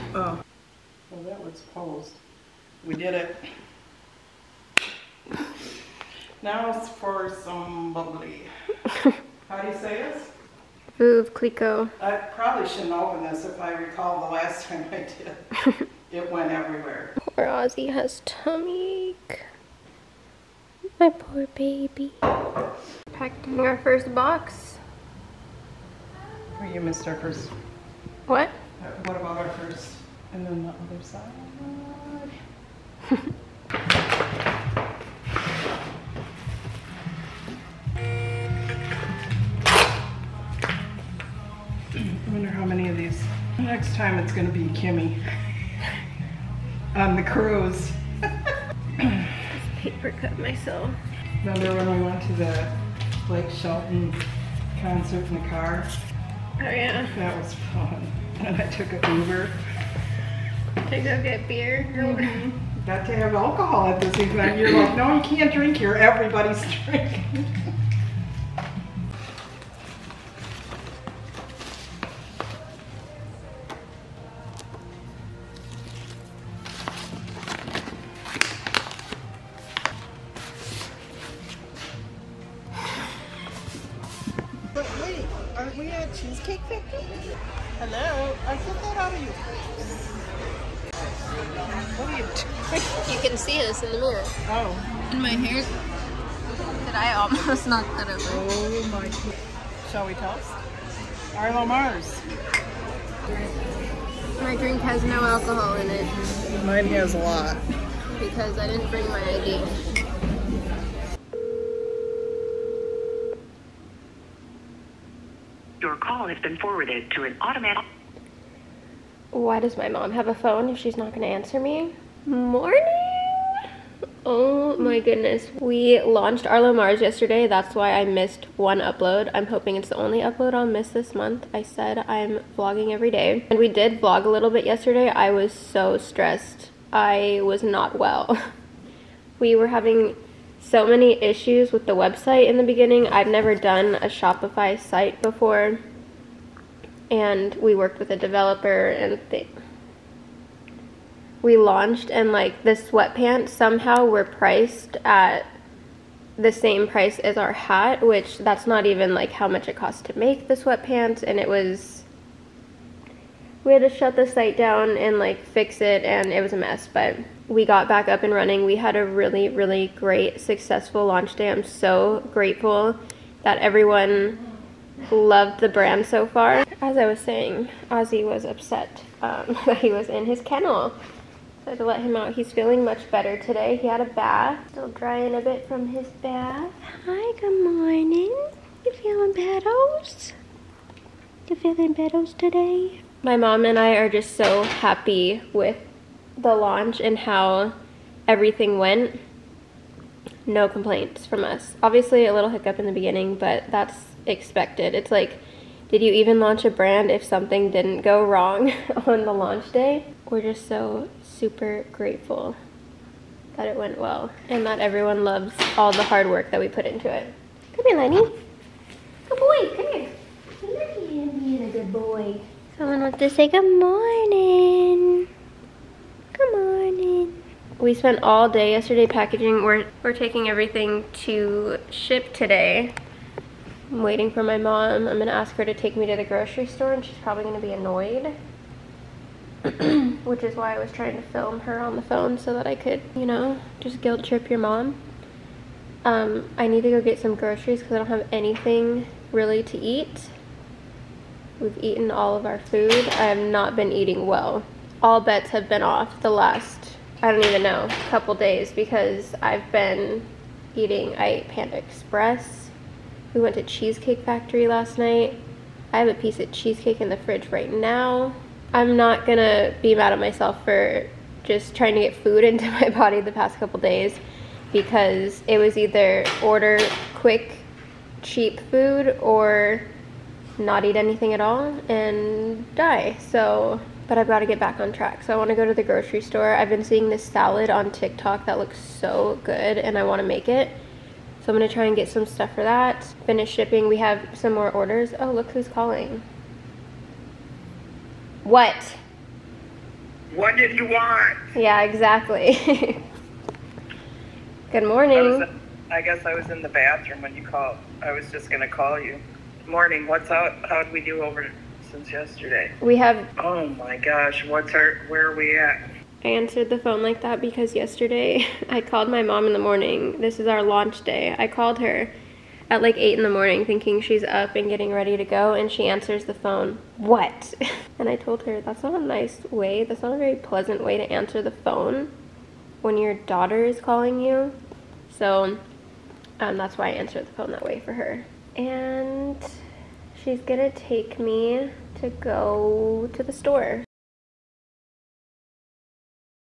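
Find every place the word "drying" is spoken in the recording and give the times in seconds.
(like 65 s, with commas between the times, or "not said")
184 s.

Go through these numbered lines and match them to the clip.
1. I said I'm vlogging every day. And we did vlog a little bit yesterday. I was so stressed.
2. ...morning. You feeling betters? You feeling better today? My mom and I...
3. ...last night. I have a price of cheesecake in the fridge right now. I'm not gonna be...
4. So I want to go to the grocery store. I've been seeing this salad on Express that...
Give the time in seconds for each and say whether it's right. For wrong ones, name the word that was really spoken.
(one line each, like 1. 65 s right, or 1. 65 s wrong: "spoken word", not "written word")
1. 131 s right
2. 187 s right
3. 264 s wrong: "piece", not "price"
4. 285 s wrong: "TikTok", not "Express".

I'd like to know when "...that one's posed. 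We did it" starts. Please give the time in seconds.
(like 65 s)
1 s.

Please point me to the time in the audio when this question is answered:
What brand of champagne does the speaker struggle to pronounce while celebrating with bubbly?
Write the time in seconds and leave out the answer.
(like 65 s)
10 s.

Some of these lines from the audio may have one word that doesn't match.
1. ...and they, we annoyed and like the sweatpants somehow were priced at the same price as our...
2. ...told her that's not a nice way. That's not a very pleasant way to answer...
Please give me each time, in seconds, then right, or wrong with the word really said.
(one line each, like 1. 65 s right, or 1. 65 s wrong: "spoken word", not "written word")
1. 148 s wrong: "launched", not "annoyed"
2. 328 s right.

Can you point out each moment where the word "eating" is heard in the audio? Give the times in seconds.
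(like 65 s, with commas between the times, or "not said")
253 s, 260 s.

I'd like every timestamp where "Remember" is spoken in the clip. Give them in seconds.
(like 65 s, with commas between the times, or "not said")
51 s.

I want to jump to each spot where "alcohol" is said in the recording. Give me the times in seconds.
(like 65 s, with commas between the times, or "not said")
63 s, 105 s.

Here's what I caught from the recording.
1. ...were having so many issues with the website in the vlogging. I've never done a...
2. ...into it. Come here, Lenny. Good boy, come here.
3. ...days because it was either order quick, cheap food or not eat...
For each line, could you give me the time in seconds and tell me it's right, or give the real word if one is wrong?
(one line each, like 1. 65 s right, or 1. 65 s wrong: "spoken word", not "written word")
1. 139 s wrong: "beginning", not "vlogging"
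2. 216 s right
3. 273 s right.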